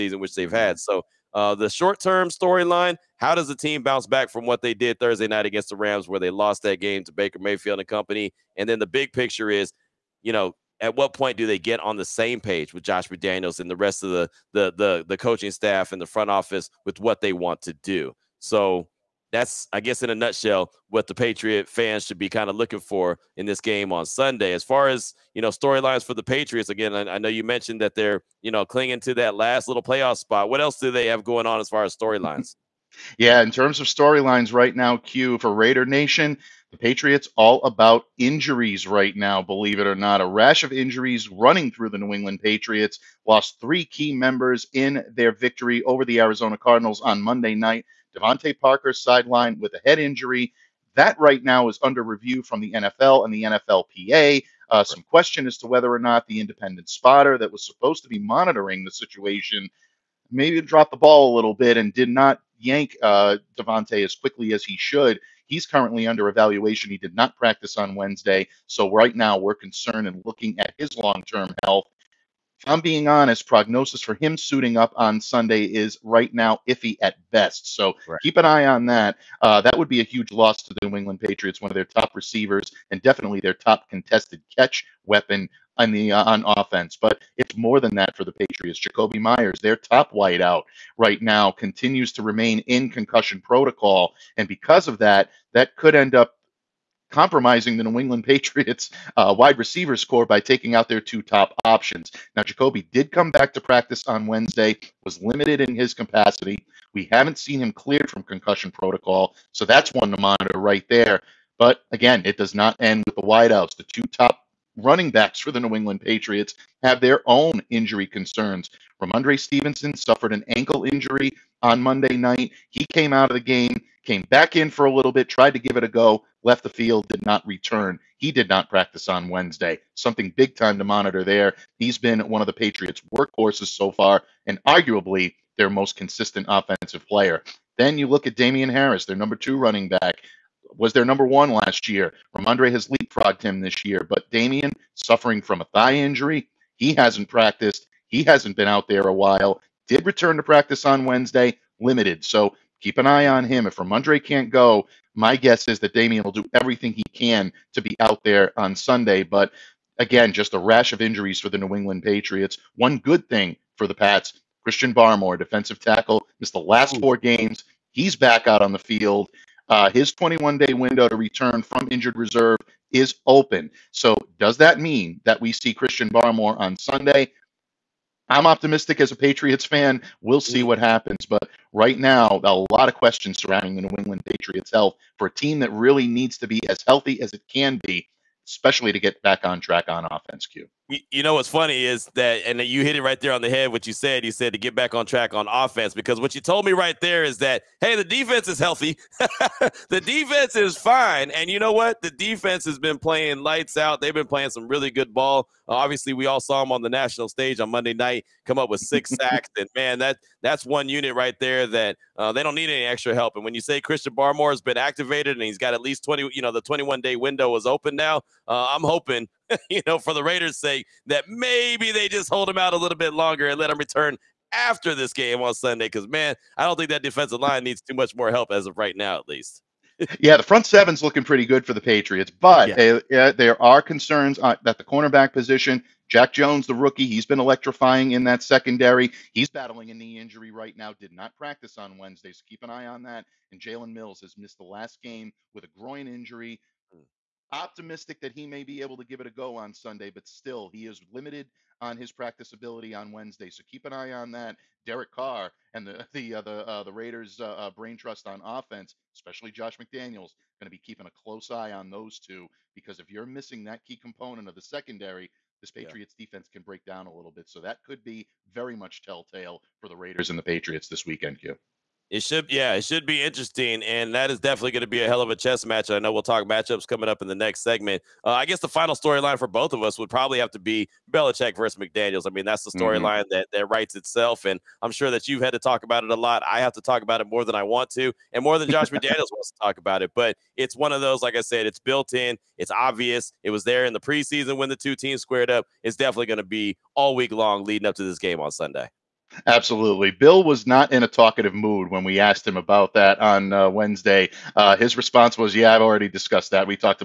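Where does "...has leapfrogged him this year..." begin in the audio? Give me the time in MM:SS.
02:22.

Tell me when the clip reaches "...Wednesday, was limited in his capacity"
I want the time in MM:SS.
01:44.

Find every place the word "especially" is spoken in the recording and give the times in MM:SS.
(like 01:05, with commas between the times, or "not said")
03:08, 04:19.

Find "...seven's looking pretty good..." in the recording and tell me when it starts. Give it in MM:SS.
03:50.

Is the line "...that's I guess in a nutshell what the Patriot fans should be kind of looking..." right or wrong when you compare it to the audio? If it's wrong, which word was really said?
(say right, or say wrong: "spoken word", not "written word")
right.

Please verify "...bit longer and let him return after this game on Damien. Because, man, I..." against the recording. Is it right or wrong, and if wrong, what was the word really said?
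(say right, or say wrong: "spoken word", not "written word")
wrong: "Sunday", not "Damien".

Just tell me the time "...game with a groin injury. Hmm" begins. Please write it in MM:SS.
04:05.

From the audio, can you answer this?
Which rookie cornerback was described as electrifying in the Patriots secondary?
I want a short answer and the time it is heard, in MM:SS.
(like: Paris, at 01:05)
Jack Jones, at 03:56.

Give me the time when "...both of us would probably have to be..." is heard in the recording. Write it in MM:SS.
04:39.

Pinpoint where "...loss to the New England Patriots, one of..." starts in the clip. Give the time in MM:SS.
01:20.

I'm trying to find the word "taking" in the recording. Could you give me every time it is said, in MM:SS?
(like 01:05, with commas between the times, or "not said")
01:40.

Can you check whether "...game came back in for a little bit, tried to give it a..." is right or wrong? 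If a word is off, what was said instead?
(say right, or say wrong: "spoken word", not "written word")
right.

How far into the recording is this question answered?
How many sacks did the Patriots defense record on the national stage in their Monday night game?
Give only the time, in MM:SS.
03:28.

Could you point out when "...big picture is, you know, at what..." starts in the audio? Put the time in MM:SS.
00:08.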